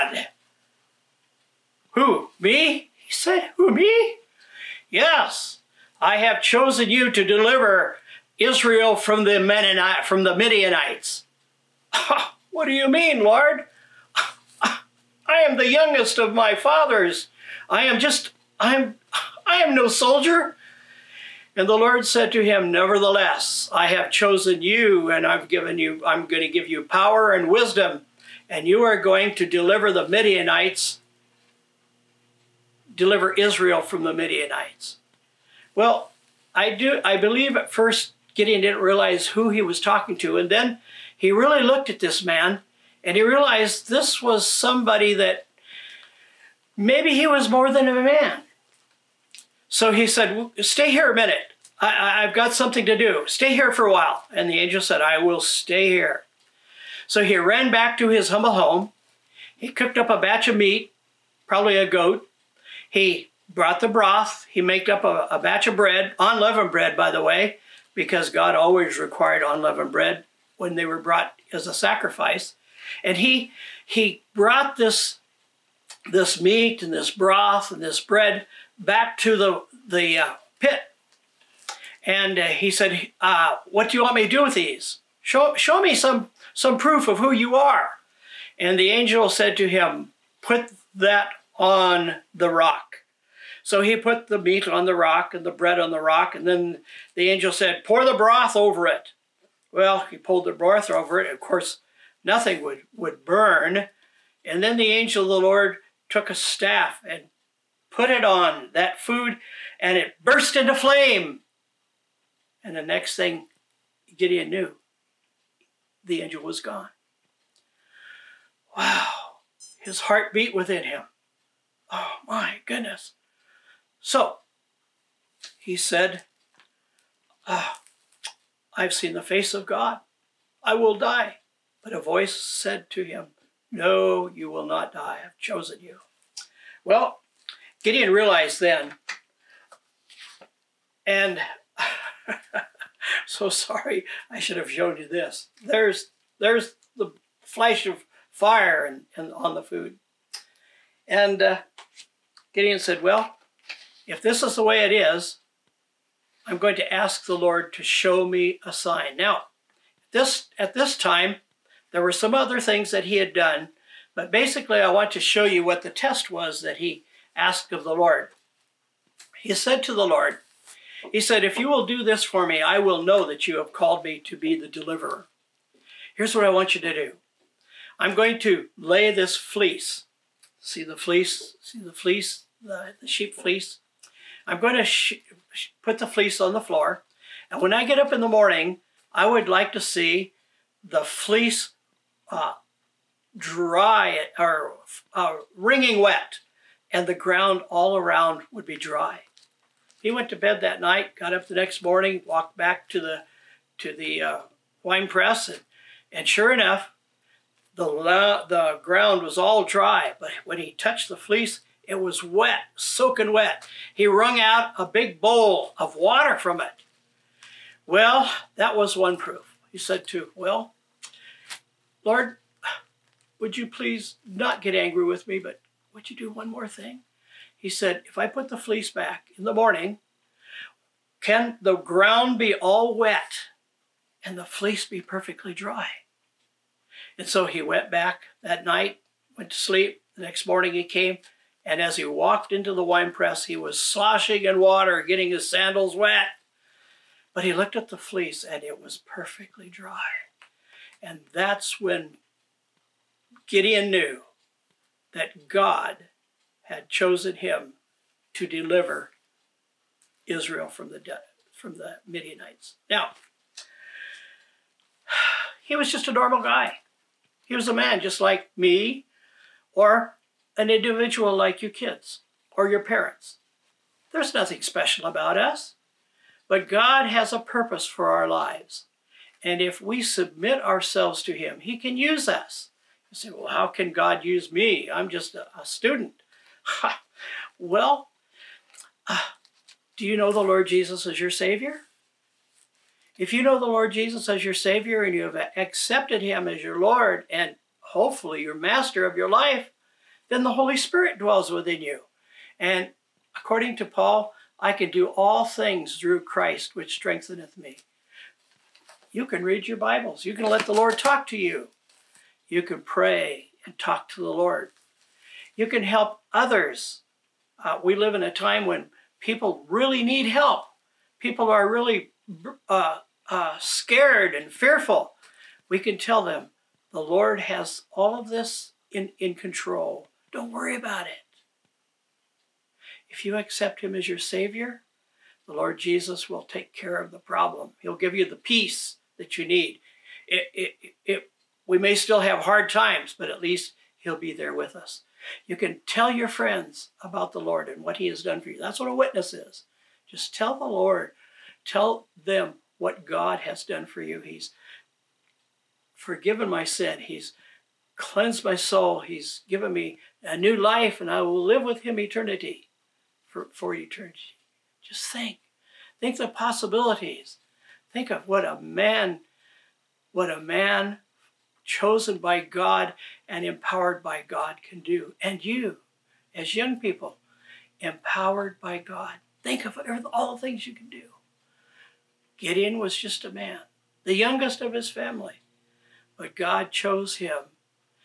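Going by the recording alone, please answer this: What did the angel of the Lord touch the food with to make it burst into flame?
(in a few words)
A staff.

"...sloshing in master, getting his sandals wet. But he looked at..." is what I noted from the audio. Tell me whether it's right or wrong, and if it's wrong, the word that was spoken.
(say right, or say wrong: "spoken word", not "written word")
wrong: "water", not "master".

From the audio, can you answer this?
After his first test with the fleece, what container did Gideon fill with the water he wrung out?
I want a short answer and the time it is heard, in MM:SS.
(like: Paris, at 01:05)
A big bowl, at 03:34.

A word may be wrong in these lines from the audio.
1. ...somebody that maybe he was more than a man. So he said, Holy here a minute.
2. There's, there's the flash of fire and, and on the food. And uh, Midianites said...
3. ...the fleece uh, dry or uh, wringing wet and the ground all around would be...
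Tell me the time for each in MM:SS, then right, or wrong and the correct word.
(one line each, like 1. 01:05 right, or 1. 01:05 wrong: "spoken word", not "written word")
1. 00:44 wrong: "Stay", not "Holy"
2. 02:25 wrong: "Gideon", not "Midianites"
3. 03:10 right.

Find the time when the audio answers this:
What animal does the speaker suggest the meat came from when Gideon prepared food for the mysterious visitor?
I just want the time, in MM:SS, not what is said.
01:01.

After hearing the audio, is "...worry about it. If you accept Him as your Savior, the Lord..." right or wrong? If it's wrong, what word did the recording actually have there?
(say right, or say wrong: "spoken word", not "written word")
right.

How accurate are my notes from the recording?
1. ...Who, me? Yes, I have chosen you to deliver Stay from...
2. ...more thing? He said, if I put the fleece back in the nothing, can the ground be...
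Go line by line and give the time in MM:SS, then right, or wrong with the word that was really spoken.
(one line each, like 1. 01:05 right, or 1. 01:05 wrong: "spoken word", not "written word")
1. 00:03 wrong: "Israel", not "Stay"
2. 03:46 wrong: "morning", not "nothing".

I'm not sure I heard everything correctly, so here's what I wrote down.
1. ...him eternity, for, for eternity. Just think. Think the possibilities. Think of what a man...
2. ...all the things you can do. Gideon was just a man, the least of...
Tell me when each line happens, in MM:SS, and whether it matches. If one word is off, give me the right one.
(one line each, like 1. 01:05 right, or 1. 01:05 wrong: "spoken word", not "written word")
1. 06:01 right
2. 06:20 wrong: "youngest", not "least".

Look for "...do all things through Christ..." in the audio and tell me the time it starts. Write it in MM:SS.
05:04.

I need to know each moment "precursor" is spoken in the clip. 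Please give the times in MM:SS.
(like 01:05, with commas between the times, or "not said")
not said.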